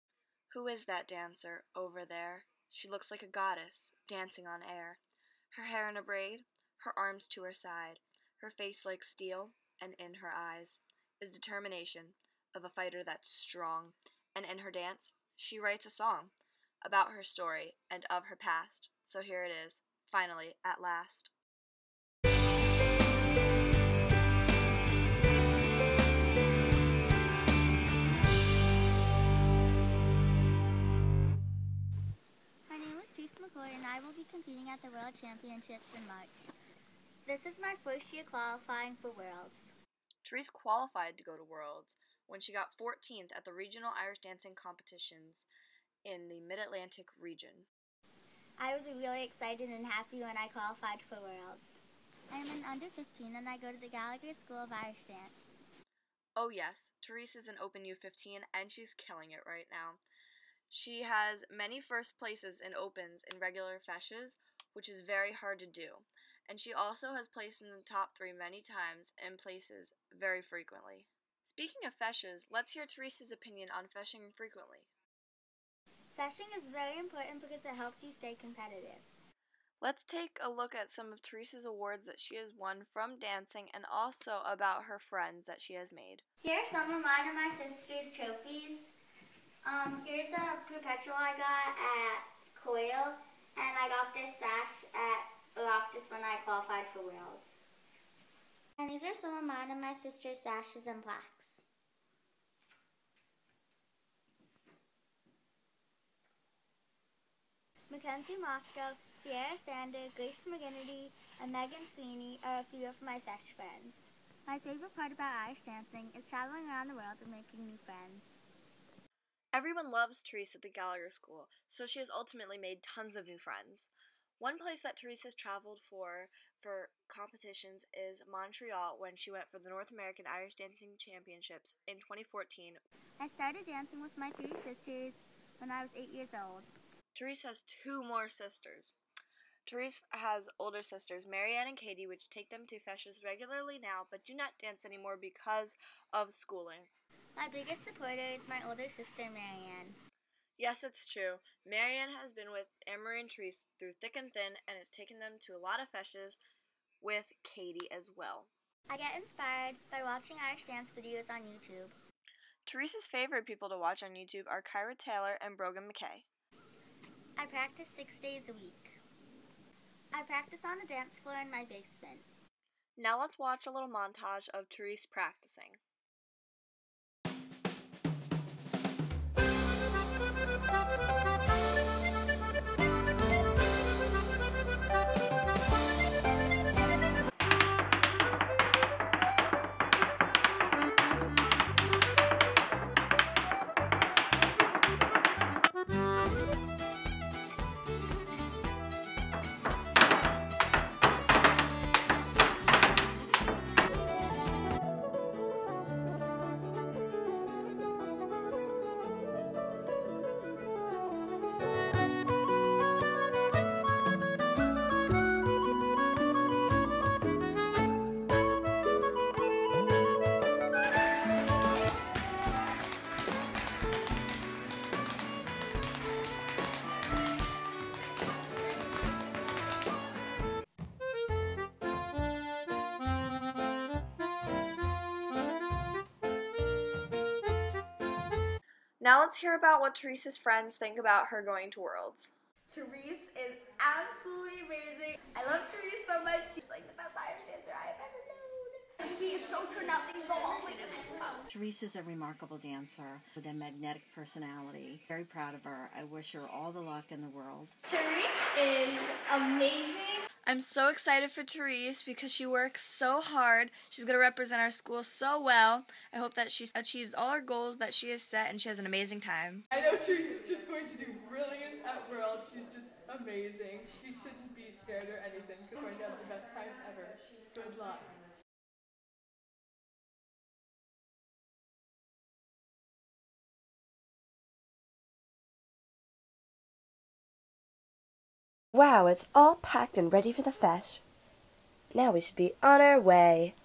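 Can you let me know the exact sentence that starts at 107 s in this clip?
Mackenzie Moscow, Sierra Sander, Grace McGinnity, and Megan Sweeney are a few of my sash friends.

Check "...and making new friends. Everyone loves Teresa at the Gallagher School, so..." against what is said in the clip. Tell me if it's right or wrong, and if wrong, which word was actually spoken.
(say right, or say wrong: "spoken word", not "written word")
right.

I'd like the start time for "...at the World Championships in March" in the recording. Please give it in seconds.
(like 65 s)
34 s.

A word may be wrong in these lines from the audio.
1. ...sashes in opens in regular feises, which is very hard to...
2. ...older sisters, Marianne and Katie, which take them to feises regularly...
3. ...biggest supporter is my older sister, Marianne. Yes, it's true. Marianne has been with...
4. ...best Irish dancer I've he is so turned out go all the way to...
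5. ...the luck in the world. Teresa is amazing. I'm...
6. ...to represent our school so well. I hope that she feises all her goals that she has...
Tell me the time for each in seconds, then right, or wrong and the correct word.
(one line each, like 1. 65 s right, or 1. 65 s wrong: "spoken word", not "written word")
1. 62 s wrong: "places", not "sashes"
2. 140 s right
3. 147 s right
4. 246 s right
5. 256 s right
6. 264 s wrong: "achieves", not "feises".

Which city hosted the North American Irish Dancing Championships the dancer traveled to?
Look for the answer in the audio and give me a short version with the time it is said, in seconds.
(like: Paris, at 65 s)
Montreal, at 128 s.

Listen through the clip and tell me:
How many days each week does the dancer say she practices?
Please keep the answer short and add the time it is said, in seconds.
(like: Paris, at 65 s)
6, at 167 s.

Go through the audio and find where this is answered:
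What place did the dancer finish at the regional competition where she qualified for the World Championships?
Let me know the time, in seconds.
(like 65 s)
42 s.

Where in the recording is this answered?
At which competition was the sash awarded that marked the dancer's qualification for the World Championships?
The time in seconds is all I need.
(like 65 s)
95 s.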